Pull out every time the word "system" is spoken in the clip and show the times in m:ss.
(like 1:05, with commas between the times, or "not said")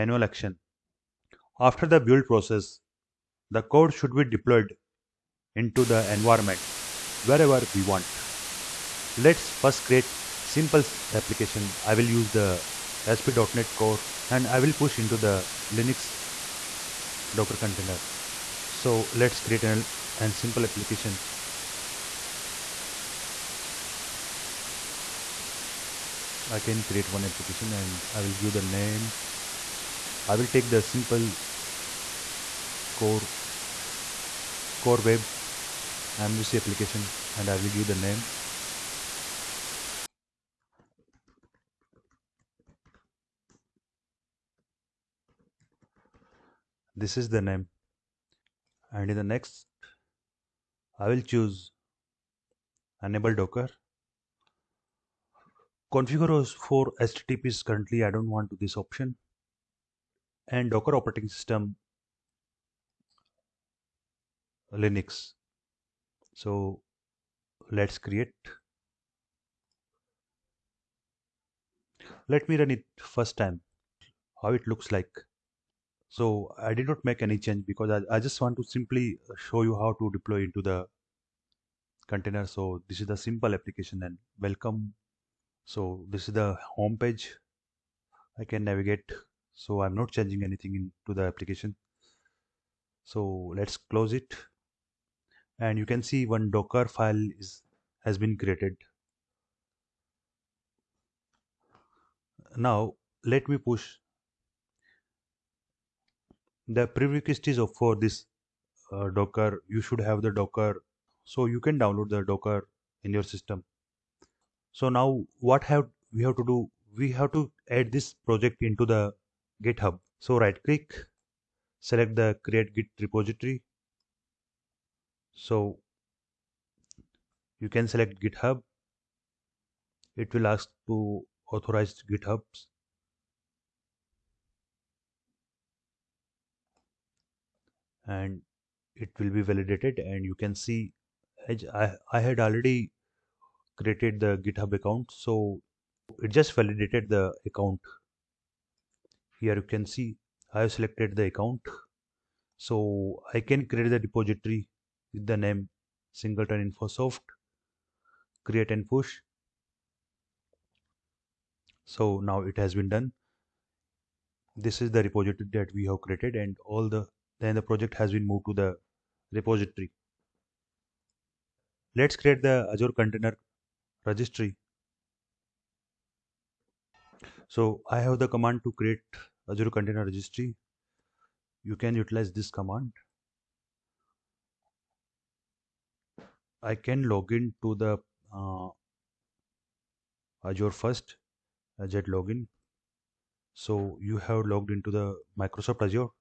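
1:01, 1:53.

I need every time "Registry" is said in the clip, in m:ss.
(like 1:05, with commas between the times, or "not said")
2:54, 3:00.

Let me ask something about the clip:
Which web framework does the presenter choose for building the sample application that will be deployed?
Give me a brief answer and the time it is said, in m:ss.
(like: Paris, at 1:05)
ASP.NET Core, at 0:13.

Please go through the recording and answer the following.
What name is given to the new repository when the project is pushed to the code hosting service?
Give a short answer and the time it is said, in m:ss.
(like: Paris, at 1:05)
singleton infosoft, at 2:36.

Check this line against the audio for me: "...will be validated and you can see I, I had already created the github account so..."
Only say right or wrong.
right.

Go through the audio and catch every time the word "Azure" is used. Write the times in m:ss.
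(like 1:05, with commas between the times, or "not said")
2:52, 2:59, 3:10.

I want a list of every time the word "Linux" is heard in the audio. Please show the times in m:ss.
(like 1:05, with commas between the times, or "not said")
0:15, 1:04.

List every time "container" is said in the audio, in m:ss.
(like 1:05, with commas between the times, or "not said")
0:17, 1:22, 2:52, 2:59.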